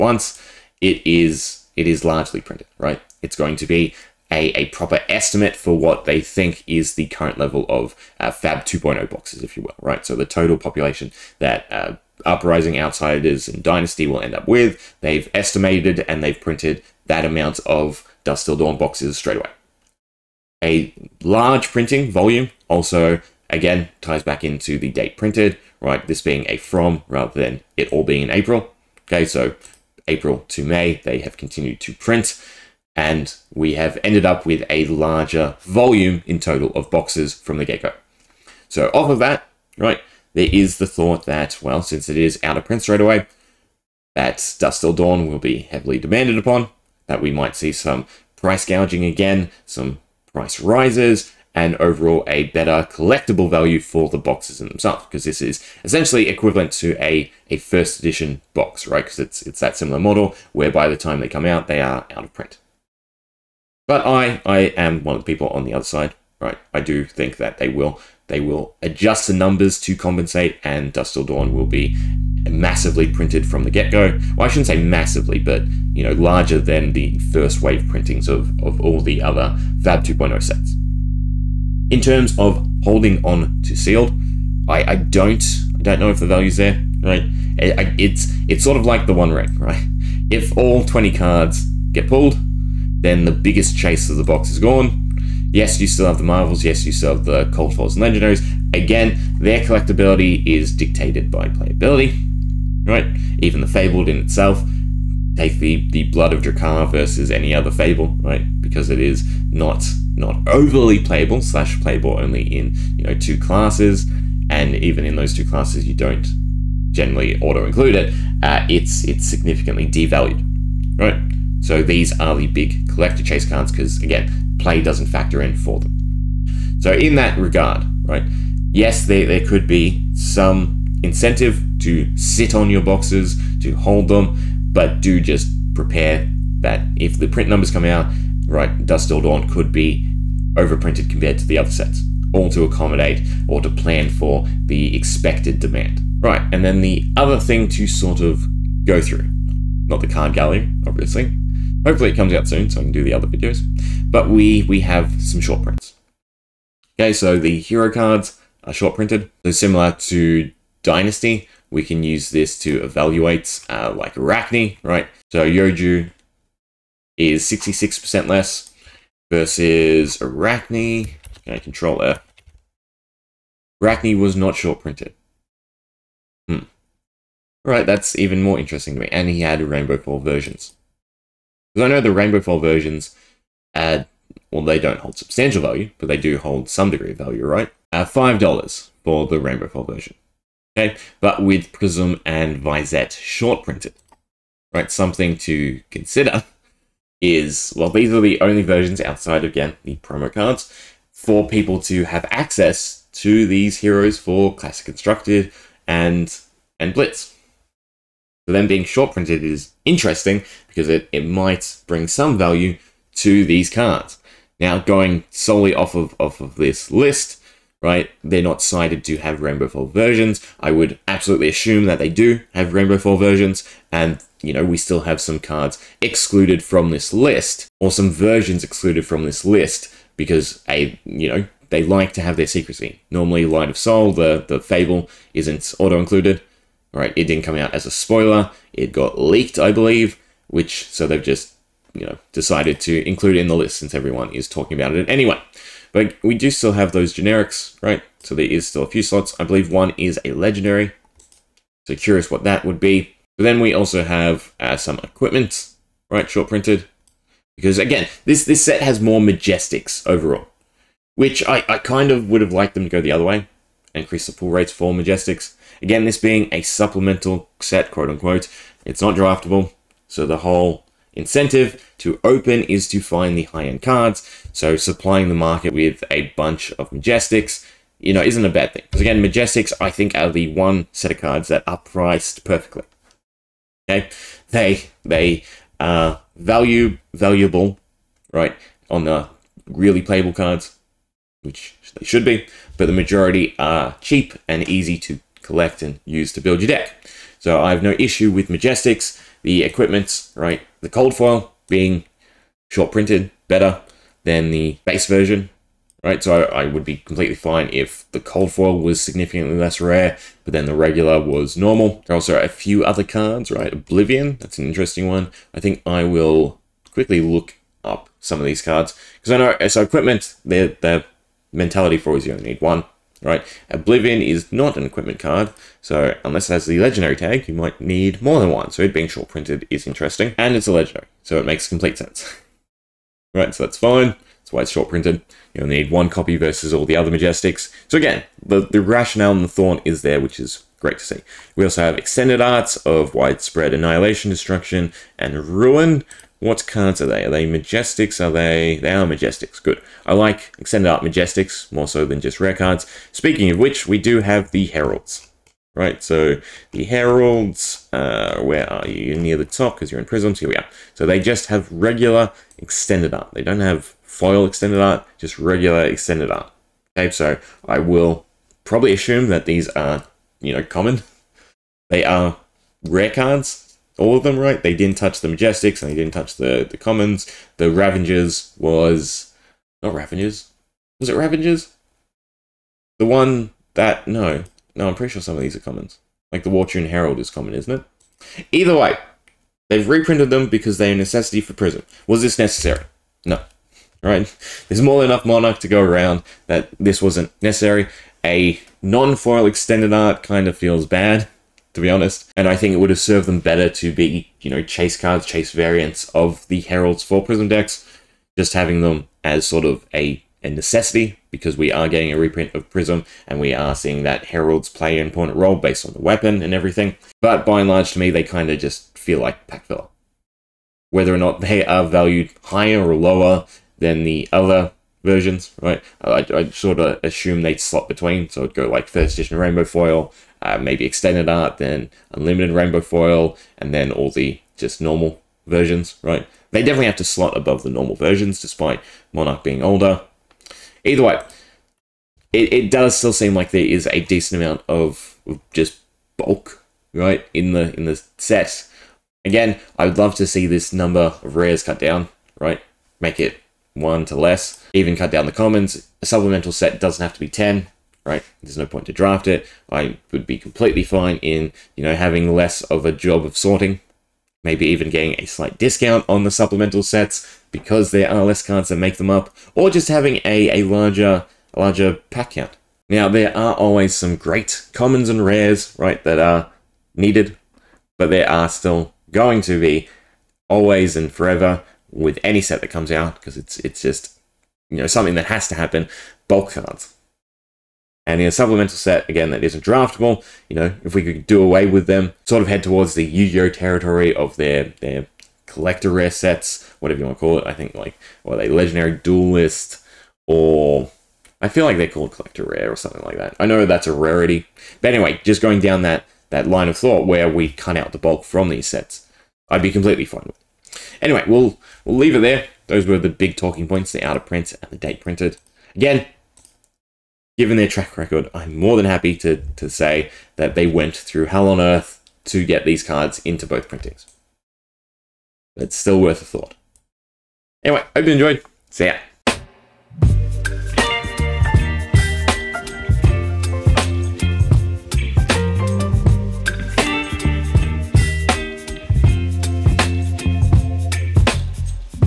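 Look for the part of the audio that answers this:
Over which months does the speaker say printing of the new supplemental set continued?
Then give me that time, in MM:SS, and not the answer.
00:30.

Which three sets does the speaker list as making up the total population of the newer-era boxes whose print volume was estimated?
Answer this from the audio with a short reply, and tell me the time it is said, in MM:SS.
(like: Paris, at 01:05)
Uprising, Outsiders, and Dynasty, at 00:12.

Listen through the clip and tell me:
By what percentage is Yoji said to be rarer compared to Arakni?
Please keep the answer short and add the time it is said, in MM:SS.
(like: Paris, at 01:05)
66%, at 02:47.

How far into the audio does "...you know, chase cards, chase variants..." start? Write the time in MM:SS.
06:44.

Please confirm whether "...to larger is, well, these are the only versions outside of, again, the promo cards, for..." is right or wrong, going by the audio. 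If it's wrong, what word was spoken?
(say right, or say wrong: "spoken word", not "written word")
wrong: "consider", not "larger".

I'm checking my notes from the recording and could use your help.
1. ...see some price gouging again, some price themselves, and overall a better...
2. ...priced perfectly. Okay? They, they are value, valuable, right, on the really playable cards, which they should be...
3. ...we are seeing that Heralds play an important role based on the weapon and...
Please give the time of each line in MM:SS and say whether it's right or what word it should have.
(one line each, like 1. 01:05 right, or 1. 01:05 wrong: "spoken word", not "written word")
1. 00:47 wrong: "rises", not "themselves"
2. 04:41 right
3. 06:53 right.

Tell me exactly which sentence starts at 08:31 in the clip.
Anyway, we'll we'll leave it there.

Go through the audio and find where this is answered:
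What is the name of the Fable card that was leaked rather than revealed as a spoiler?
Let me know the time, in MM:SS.
03:53.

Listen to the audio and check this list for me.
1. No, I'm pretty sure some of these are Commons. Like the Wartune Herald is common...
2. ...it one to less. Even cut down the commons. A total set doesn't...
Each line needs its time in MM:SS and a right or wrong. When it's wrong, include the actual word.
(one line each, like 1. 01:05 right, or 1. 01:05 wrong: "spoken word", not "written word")
1. 06:24 right
2. 07:33 wrong: "supplemental", not "total".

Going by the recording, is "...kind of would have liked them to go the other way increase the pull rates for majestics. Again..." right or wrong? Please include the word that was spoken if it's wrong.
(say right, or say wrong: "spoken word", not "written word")
right.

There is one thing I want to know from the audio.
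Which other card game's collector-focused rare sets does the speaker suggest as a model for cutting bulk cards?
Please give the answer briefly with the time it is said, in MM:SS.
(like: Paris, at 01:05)
Yu-Gi-Oh, at 08:13.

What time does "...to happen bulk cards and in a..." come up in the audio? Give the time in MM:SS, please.
08:05.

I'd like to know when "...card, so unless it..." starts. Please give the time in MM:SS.
05:25.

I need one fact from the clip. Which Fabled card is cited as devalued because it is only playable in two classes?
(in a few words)
Blood of Dracai.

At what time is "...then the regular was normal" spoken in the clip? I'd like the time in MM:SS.
05:10.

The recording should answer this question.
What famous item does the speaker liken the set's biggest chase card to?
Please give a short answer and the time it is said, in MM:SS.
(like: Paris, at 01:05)
The one ring, at 01:29.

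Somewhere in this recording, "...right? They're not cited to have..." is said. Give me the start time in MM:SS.
03:37.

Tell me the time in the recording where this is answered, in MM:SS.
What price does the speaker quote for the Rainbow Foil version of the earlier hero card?
03:08.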